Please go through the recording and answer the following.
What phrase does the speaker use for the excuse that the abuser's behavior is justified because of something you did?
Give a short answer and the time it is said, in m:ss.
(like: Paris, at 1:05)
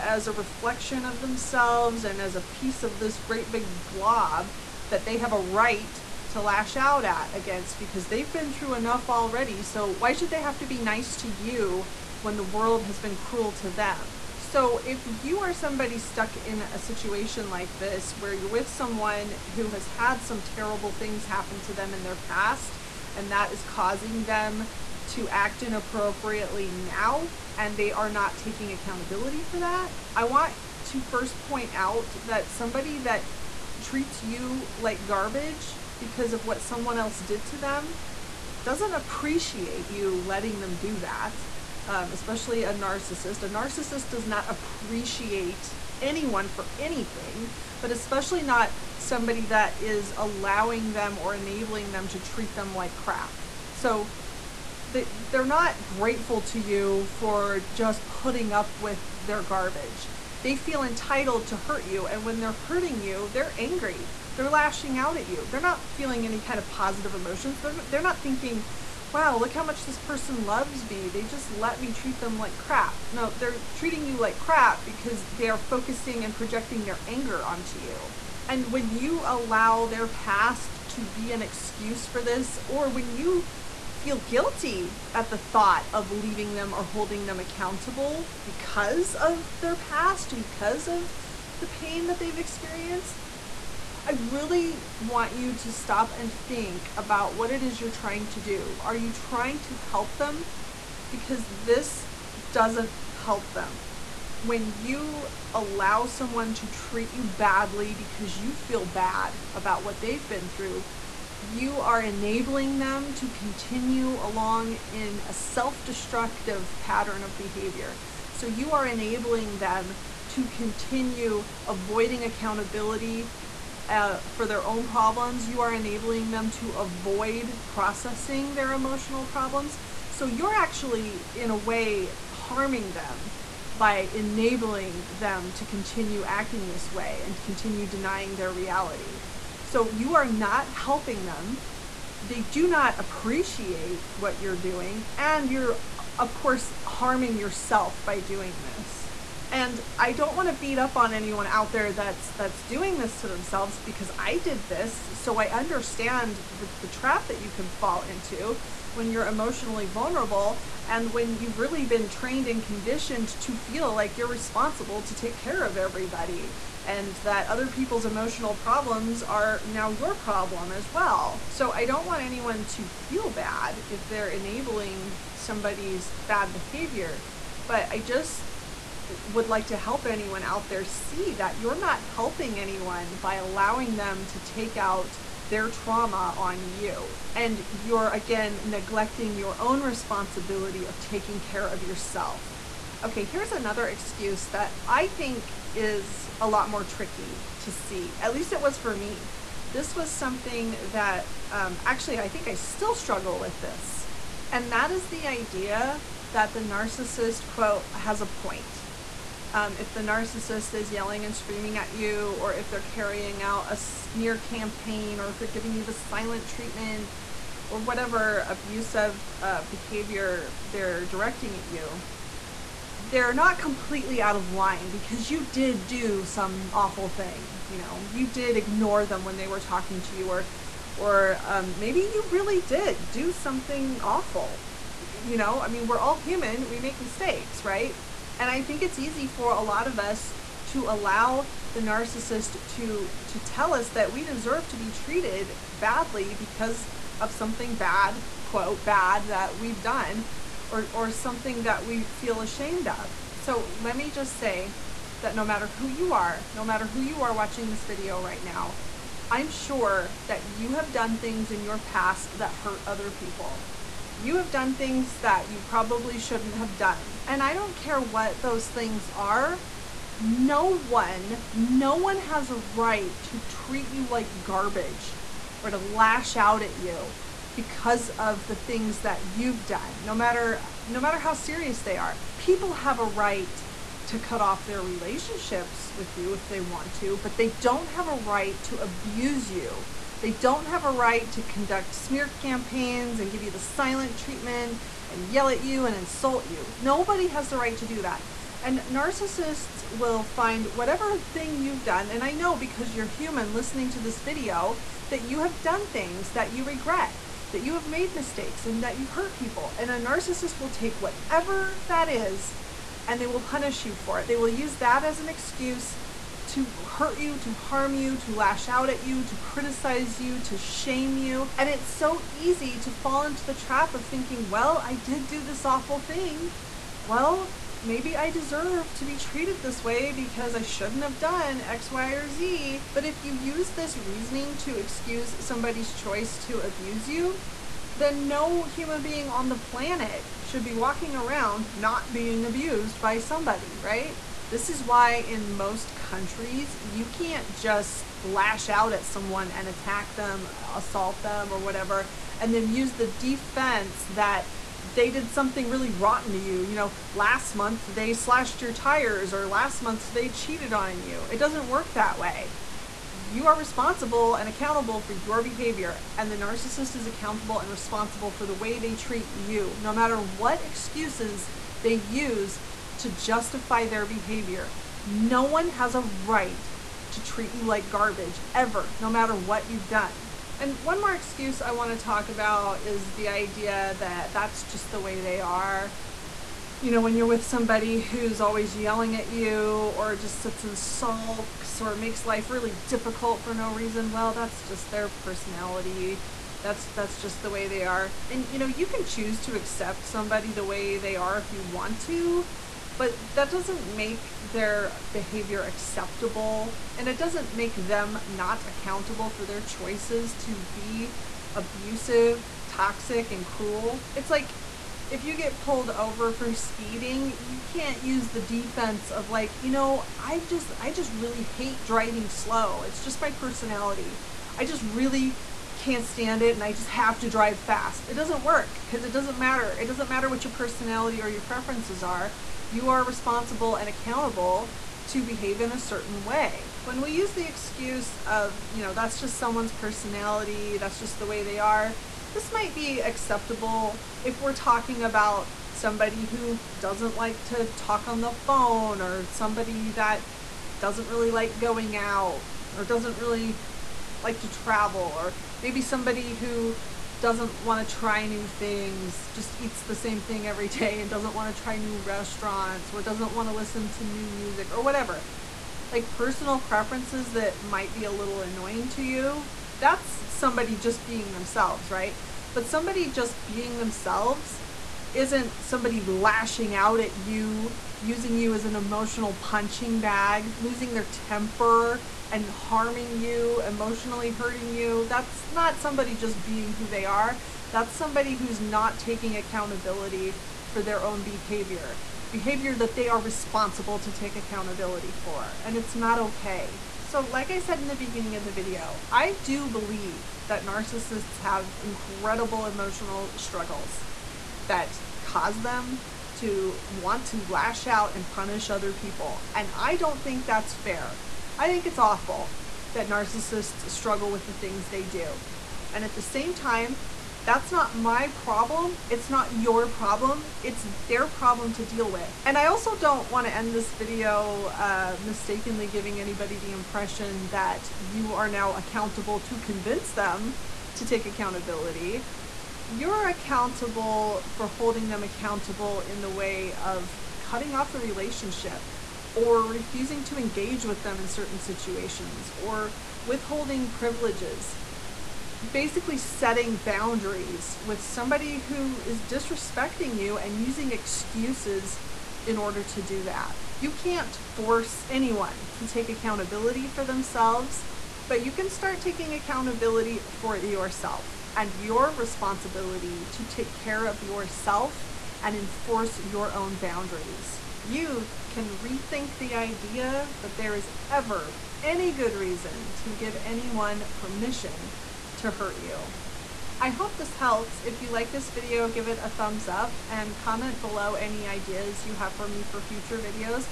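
has a point, at 3:27.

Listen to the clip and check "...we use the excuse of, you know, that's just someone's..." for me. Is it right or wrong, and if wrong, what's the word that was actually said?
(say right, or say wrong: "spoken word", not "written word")
right.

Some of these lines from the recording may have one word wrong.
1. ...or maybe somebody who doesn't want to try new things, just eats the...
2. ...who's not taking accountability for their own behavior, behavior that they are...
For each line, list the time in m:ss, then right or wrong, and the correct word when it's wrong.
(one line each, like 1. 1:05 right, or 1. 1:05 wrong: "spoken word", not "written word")
1. 7:35 right
2. 8:08 right.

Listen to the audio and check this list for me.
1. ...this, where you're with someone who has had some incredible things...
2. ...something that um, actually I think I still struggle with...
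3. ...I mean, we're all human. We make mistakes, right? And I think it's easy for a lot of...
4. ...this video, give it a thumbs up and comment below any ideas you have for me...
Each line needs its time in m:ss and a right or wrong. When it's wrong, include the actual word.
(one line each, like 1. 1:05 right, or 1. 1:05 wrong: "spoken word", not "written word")
1. 0:17 wrong: "terrible", not "incredible"
2. 3:20 right
3. 3:55 right
4. 9:38 right.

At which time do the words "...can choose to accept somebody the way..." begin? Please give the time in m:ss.
6:38.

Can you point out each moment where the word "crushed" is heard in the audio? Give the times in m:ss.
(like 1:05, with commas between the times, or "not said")
not said.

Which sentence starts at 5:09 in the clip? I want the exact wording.
And a narcissist will take whatever that is and they will punish you for it.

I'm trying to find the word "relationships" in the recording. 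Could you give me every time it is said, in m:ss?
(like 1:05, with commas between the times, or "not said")
4:44, 8:58.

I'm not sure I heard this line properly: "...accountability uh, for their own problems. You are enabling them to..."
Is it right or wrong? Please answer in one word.
right.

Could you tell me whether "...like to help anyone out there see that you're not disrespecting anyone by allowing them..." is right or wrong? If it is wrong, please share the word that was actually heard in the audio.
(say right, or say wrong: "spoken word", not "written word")
wrong: "helping", not "disrespecting".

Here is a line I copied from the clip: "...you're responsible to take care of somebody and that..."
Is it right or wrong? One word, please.
wrong.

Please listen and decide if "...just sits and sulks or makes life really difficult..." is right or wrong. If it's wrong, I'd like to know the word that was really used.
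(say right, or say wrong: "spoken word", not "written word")
right.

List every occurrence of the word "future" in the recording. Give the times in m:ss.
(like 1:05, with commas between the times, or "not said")
9:42.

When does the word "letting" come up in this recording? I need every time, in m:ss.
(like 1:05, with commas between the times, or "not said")
0:40.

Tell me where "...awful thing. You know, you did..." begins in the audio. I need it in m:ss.
3:46.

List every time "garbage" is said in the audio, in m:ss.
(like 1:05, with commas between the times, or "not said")
0:35, 0:59, 4:34, 6:17.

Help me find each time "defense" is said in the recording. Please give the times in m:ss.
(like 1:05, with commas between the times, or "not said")
5:53, 6:58.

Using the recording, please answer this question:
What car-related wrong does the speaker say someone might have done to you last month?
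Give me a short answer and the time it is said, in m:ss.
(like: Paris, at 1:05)
slashed your tires, at 5:58.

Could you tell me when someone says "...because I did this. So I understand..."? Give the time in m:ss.
2:33.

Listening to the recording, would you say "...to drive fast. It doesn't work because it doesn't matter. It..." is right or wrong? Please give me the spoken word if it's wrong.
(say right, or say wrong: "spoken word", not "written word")
right.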